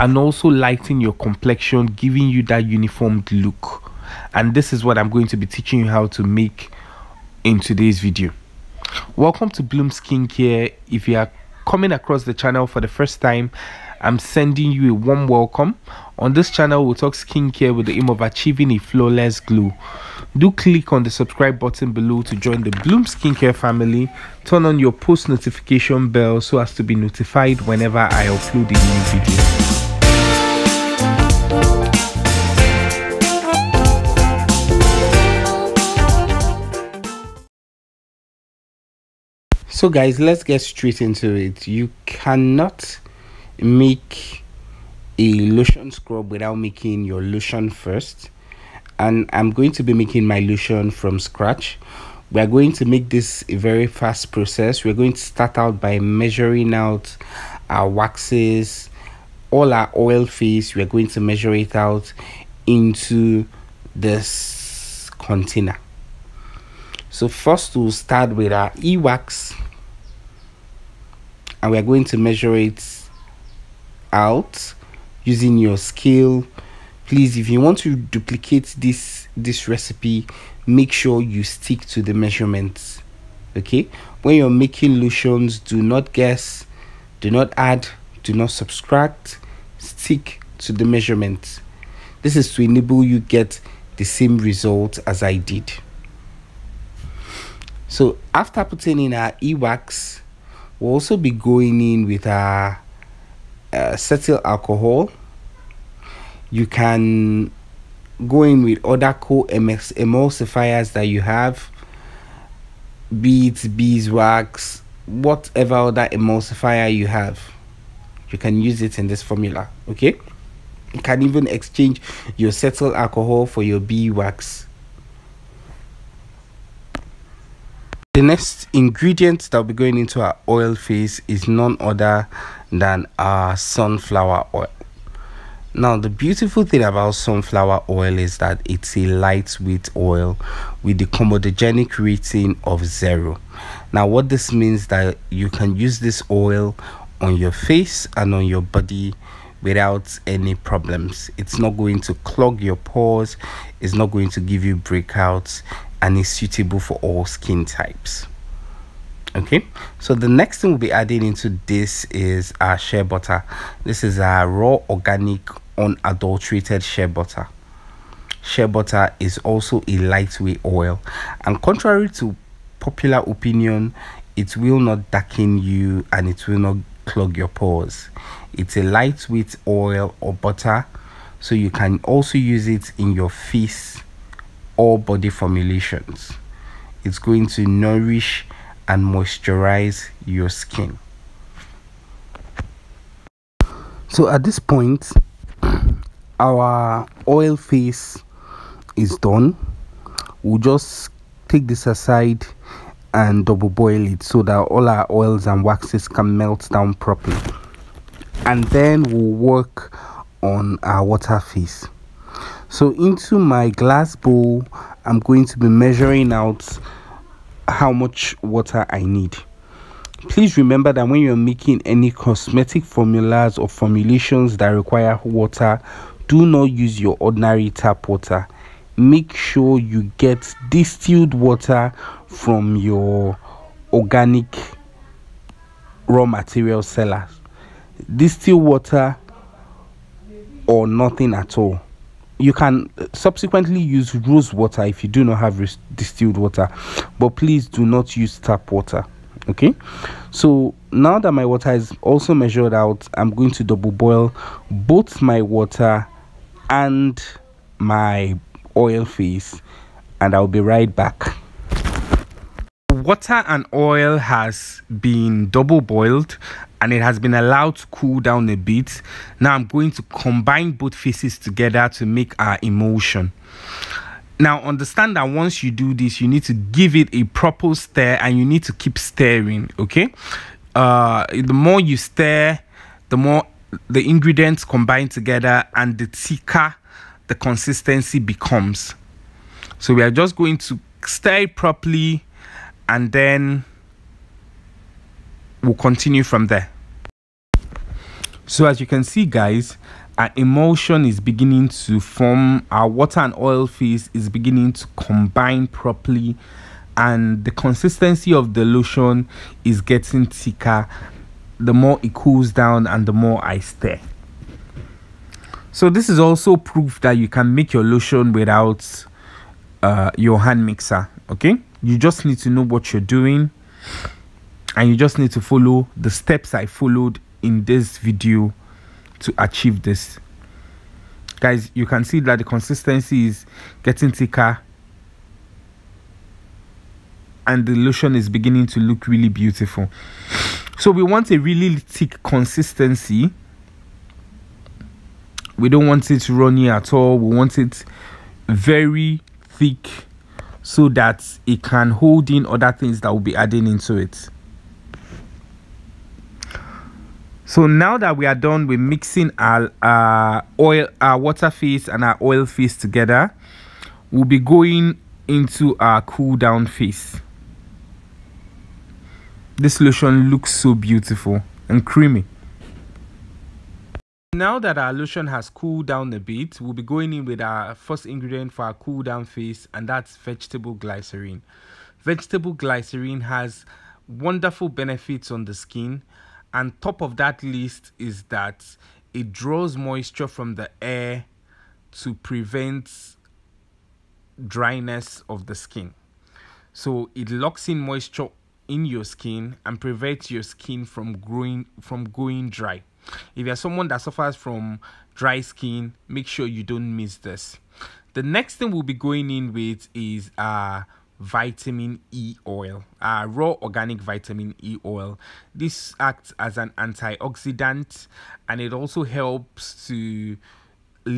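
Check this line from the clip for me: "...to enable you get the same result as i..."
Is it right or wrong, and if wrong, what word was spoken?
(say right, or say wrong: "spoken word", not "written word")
right.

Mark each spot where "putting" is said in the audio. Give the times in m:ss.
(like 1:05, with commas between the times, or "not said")
1:38.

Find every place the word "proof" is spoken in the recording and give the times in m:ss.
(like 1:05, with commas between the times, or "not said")
5:16.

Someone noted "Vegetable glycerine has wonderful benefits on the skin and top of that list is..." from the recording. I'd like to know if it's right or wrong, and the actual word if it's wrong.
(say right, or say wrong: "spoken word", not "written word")
right.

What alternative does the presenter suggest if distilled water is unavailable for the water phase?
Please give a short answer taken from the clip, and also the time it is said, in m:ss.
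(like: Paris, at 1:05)
rose water, at 4:04.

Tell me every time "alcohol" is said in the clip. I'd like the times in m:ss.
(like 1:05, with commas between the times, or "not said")
1:44, 2:02.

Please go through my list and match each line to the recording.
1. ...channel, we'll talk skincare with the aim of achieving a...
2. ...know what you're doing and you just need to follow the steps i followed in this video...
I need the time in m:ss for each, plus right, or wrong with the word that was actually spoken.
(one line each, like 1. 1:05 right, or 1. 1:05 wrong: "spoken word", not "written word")
1. 0:16 right
2. 5:22 right.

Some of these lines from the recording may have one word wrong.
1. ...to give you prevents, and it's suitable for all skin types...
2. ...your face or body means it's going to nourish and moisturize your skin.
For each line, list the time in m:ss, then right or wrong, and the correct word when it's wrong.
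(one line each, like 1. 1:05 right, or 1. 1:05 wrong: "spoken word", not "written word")
1. 2:34 wrong: "breakouts", not "prevents"
2. 3:03 wrong: "formulations", not "means".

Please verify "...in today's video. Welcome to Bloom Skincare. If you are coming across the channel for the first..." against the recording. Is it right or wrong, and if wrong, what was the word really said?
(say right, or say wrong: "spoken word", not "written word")
right.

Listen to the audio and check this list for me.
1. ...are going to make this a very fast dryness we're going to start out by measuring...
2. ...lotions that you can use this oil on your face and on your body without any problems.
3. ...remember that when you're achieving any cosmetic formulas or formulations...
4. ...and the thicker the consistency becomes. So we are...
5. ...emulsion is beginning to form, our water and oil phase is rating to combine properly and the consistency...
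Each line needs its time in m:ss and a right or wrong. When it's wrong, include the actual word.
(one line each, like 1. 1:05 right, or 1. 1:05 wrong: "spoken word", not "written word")
1. 0:52 wrong: "process", not "dryness"
2. 2:24 wrong: "means", not "lotions"
3. 3:40 wrong: "making", not "achieving"
4. 4:45 right
5. 5:00 wrong: "beginning", not "rating".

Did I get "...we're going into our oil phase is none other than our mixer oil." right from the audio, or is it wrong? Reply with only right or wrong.
wrong.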